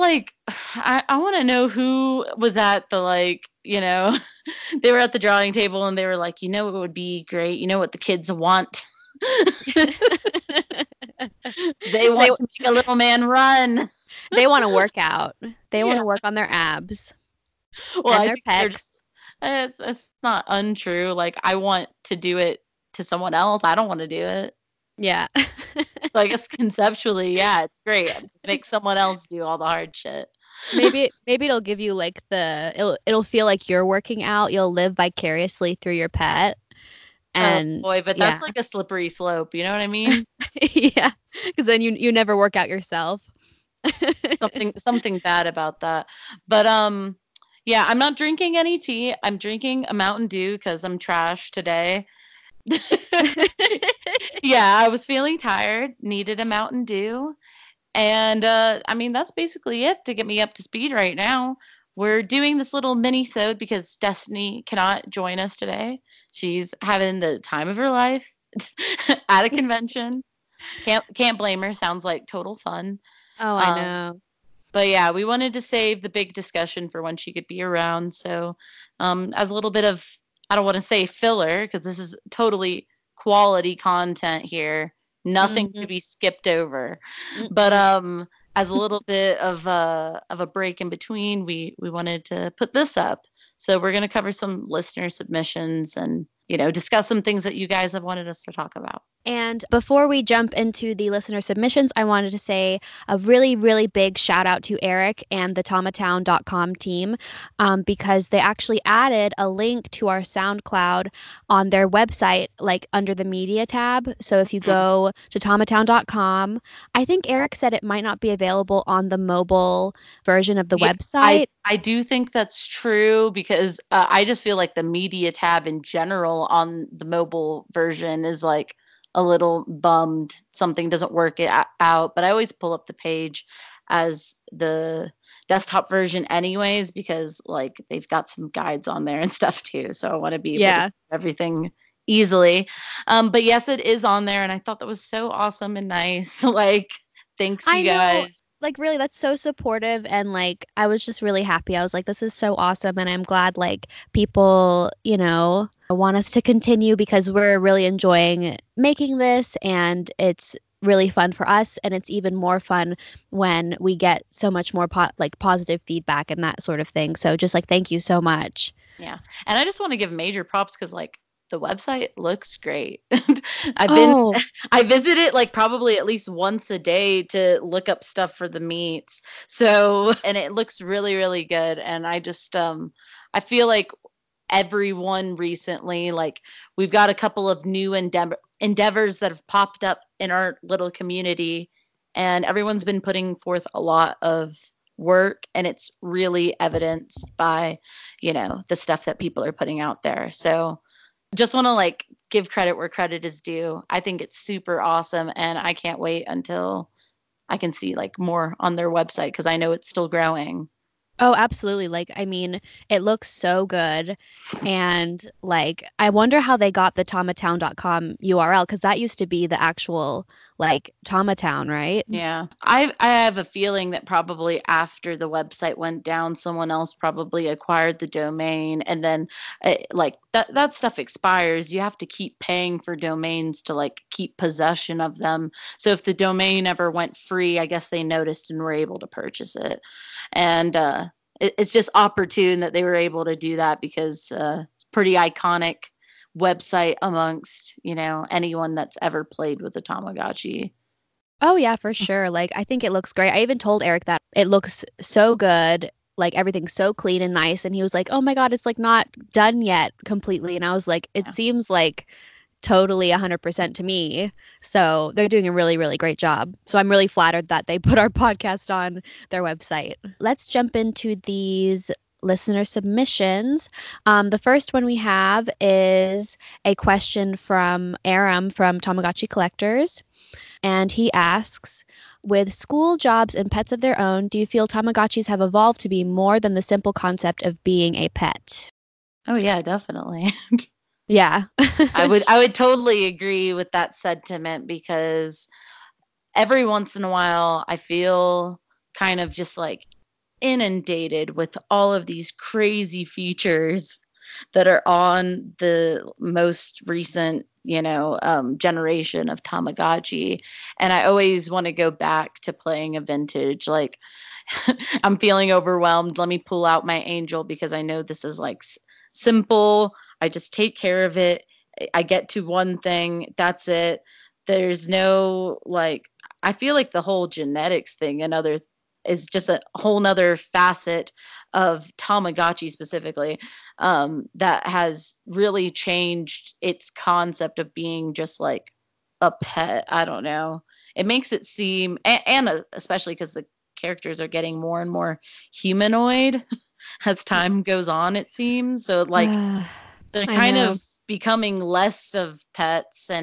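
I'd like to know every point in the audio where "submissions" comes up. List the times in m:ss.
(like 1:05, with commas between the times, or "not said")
1:35, 1:41, 4:32.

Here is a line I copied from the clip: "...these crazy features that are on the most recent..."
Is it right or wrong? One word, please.
right.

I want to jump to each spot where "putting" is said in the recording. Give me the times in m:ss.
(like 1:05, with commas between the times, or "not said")
3:13, 3:19.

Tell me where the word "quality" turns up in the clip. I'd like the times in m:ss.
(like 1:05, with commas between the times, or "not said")
1:23.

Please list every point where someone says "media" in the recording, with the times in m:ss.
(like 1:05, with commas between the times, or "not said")
1:53, 2:04.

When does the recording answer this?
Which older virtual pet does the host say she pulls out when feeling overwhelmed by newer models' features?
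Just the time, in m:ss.
5:17.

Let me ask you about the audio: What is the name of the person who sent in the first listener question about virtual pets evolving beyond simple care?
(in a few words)
Aram.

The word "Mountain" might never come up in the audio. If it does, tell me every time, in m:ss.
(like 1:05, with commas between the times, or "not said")
0:49, 0:56.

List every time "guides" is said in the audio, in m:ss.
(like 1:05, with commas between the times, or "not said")
2:18.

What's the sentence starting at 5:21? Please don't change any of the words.
I get to one thing, that's it.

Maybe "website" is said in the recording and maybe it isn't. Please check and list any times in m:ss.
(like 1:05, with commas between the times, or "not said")
1:51, 2:00, 2:51, 3:28, 3:45, 4:06, 4:29.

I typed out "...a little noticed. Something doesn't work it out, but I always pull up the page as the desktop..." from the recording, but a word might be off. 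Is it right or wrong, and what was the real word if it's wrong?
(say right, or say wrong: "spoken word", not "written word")
wrong: "bummed", not "noticed".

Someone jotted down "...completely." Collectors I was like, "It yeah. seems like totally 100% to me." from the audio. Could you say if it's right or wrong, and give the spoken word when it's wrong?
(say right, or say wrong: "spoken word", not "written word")
wrong: "And", not "Collectors".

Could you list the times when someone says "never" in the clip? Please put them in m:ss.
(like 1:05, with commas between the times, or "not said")
0:42.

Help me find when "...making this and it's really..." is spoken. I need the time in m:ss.
2:38.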